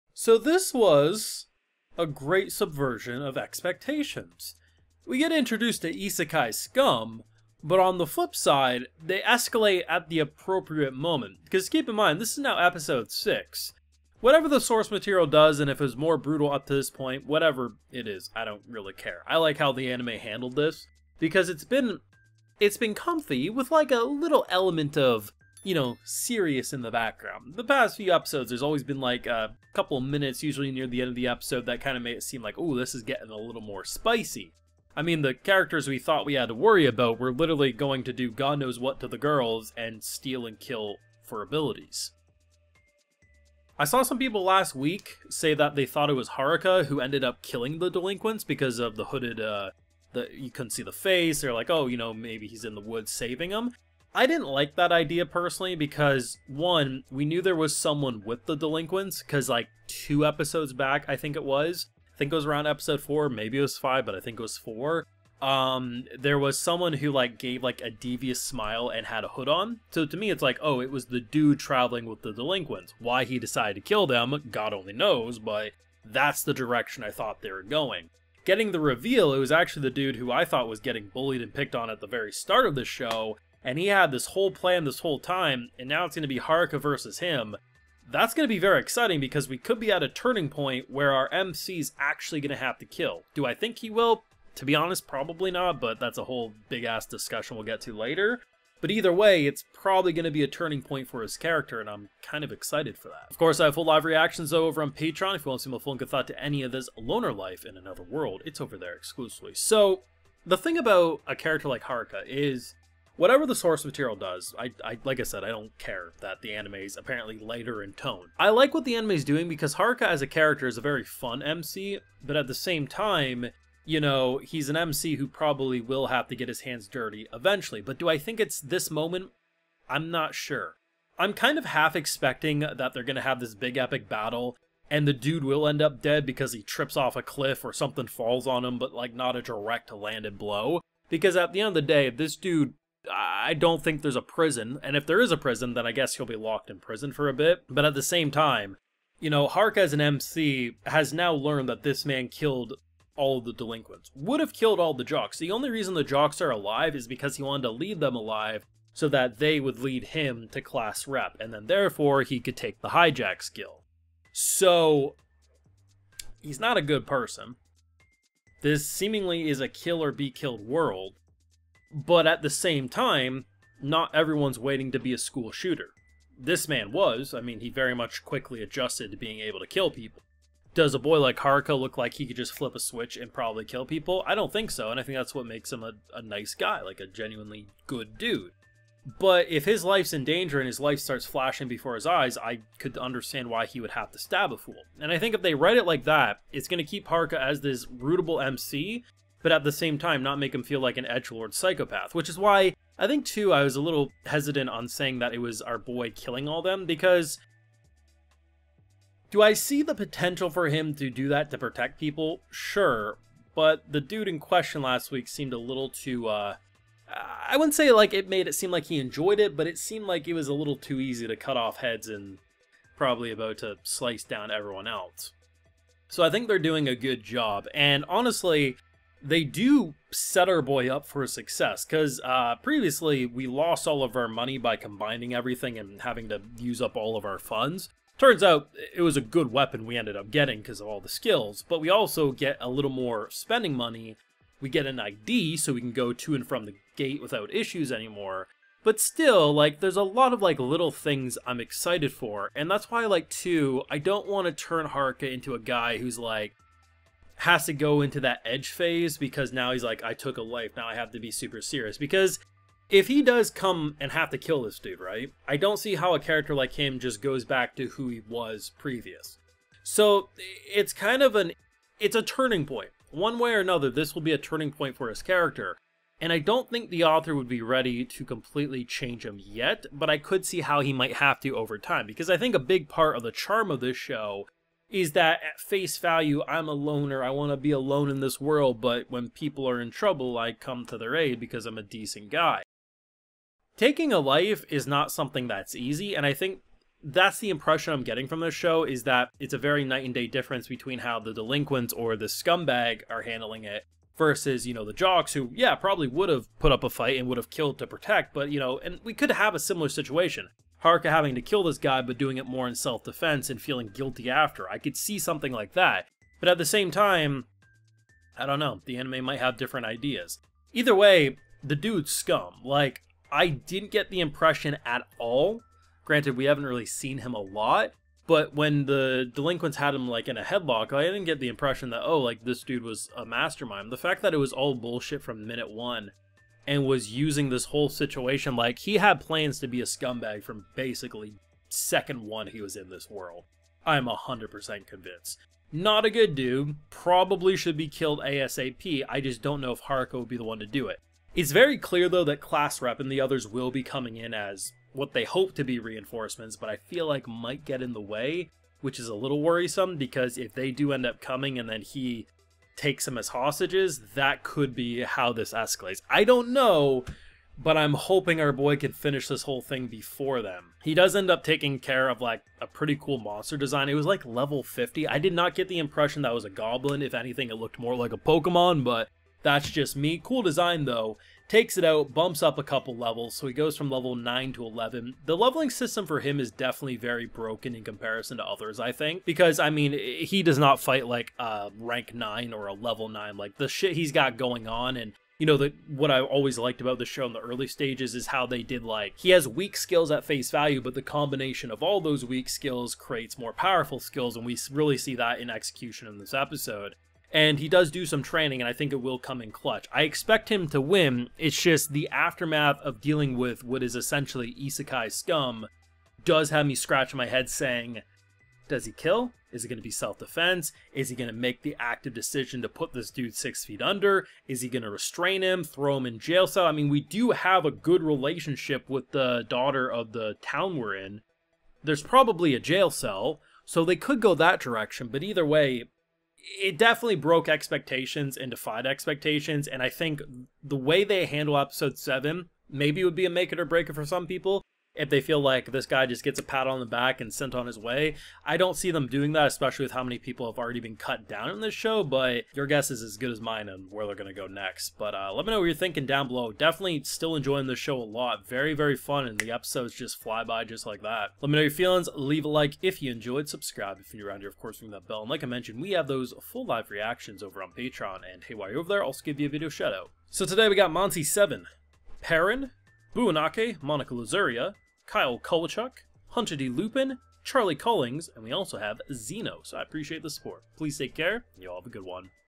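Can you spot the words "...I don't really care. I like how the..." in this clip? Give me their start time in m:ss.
0:18.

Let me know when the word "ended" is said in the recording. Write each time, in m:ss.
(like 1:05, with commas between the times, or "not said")
0:46, 3:59.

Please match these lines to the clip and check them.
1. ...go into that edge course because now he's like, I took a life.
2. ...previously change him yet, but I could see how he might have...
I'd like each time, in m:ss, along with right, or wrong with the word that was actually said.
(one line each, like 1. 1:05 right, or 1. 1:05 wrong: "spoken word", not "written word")
1. 4:17 wrong: "phase", not "course"
2. 4:38 wrong: "completely", not "previously".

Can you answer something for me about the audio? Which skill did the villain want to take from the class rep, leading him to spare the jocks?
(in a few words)
Hijack.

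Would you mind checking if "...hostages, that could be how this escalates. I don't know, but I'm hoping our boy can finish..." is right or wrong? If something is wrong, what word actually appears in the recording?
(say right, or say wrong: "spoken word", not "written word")
right.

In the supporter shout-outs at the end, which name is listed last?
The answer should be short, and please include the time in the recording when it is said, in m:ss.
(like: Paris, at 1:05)
Zeno, at 7:59.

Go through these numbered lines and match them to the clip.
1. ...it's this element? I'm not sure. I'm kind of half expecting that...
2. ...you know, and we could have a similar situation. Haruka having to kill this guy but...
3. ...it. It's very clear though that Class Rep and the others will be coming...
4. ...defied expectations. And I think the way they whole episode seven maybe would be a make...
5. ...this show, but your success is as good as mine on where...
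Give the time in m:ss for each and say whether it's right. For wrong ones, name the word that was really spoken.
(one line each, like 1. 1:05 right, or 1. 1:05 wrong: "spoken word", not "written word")
1. 2:08 wrong: "moment", not "element"
2. 5:08 right
3. 5:50 right
4. 7:18 wrong: "handle", not "whole"
5. 7:31 wrong: "guess", not "success".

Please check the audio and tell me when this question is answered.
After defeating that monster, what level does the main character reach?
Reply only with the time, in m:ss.
6:24.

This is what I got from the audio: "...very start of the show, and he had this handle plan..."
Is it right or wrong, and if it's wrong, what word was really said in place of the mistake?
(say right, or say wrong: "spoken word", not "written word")
wrong: "whole", not "handle".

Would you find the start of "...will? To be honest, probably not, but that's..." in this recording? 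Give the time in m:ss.
1:33.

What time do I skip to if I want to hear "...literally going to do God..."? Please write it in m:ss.
0:37.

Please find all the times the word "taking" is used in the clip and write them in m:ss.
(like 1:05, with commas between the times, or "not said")
4:53, 6:11.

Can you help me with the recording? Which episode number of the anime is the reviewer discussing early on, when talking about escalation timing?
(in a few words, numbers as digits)
6.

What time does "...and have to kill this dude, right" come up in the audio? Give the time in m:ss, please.
4:23.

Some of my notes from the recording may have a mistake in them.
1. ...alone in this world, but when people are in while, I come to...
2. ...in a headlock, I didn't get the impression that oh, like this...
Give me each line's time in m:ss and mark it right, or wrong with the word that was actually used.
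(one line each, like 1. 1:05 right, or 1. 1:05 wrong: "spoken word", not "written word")
1. 4:47 wrong: "trouble", not "while"
2. 5:30 right.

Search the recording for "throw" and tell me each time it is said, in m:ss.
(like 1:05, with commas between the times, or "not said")
7:05.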